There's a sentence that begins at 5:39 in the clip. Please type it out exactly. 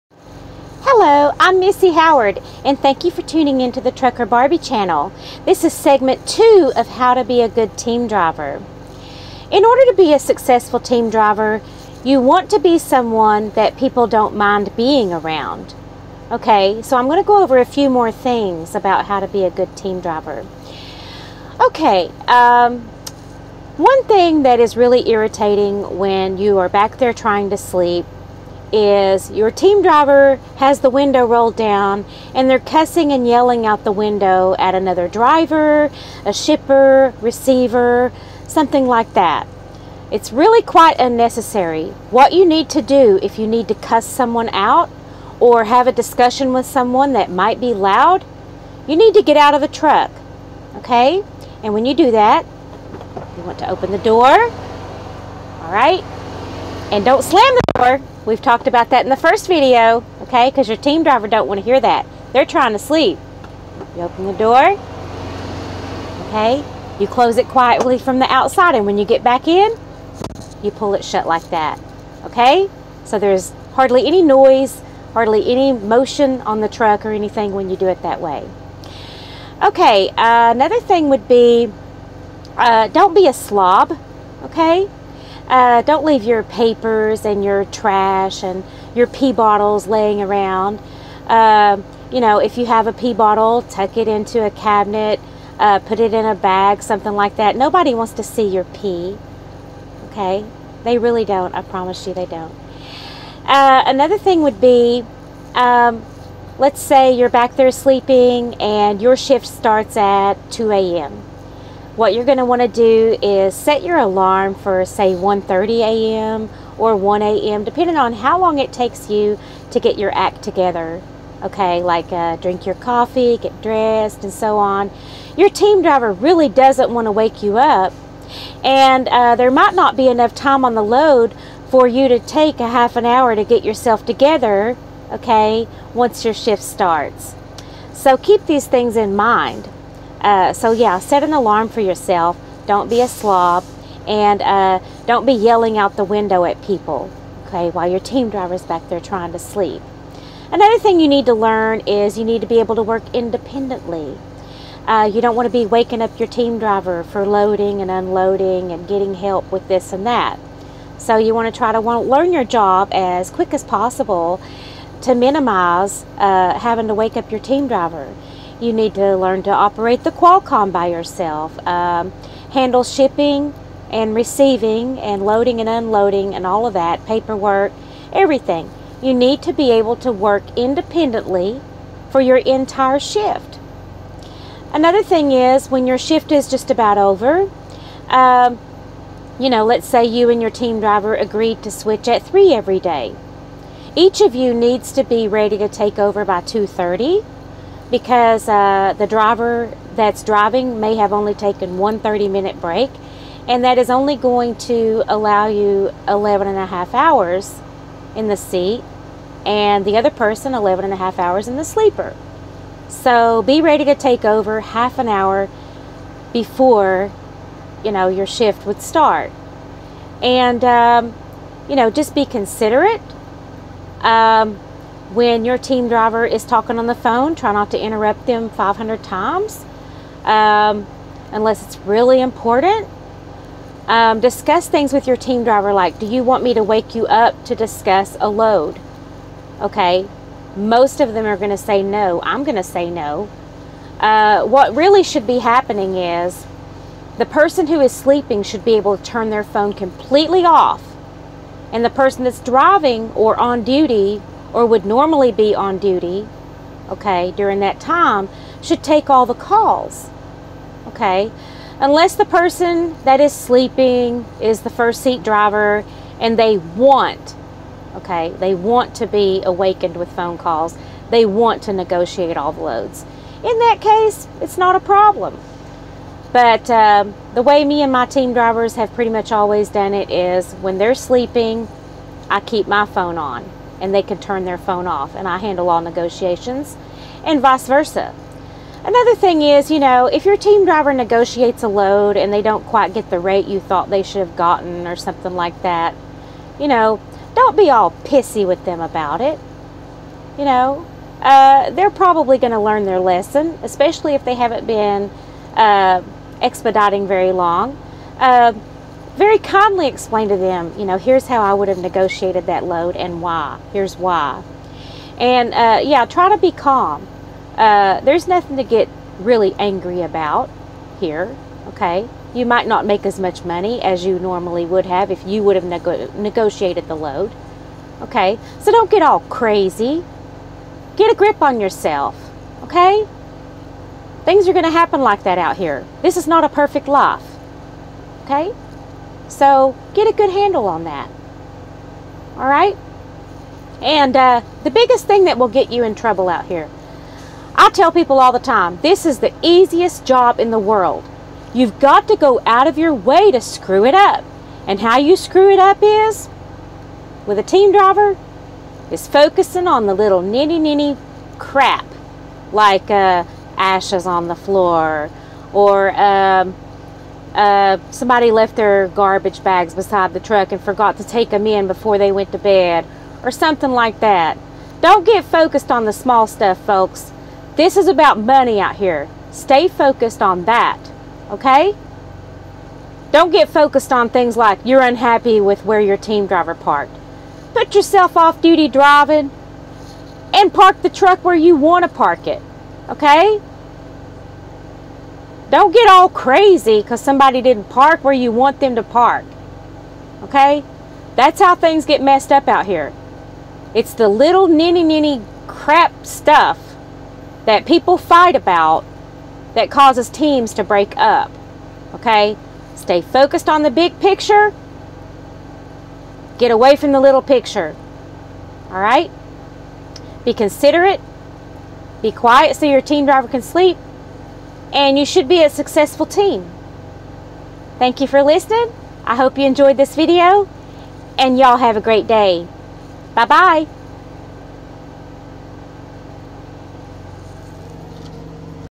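So get a good handle on that.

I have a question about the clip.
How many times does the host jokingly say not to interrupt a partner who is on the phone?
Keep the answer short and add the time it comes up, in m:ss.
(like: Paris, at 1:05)
500, at 3:48.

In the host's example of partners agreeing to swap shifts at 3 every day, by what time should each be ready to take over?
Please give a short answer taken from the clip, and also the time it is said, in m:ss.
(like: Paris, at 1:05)
2:30, at 3:16.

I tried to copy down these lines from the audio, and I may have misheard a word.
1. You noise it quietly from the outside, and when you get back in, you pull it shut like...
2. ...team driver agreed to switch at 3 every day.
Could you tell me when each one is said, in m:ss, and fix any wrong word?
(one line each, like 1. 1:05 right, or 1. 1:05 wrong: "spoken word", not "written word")
1. 1:06 wrong: "close", not "noise"
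2. 3:10 right.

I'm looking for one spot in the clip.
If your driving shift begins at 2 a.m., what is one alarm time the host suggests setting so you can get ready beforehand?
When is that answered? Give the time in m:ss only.
1:55.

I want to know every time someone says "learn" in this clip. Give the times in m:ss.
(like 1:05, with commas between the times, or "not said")
2:31, 2:42, 2:49, 5:02.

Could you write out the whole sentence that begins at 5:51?
You've got to go out of your way to screw it up.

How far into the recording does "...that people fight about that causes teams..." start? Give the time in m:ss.
6:47.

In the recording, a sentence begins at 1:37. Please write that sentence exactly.
Nobody wants to see your pee.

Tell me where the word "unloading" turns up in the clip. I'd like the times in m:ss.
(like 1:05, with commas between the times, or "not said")
2:37, 2:55.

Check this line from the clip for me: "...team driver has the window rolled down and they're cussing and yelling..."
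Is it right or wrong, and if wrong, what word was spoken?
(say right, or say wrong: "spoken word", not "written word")
right.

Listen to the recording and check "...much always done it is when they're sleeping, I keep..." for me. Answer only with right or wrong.
right.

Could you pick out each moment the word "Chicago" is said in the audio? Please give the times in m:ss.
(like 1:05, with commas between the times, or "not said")
not said.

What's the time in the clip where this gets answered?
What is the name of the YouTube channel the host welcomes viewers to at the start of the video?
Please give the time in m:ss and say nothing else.
0:03.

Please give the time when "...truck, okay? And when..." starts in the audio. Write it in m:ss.
0:49.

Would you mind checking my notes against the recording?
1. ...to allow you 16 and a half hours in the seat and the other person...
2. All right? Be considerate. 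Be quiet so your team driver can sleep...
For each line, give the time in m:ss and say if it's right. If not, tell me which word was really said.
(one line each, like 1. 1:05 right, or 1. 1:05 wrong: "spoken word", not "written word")
1. 3:24 wrong: "11", not "16"
2. 6:58 right.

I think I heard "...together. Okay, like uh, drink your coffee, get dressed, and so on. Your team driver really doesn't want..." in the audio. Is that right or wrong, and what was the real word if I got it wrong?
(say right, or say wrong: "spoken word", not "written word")
right.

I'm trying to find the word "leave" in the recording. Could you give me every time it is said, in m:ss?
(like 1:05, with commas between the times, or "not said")
1:26.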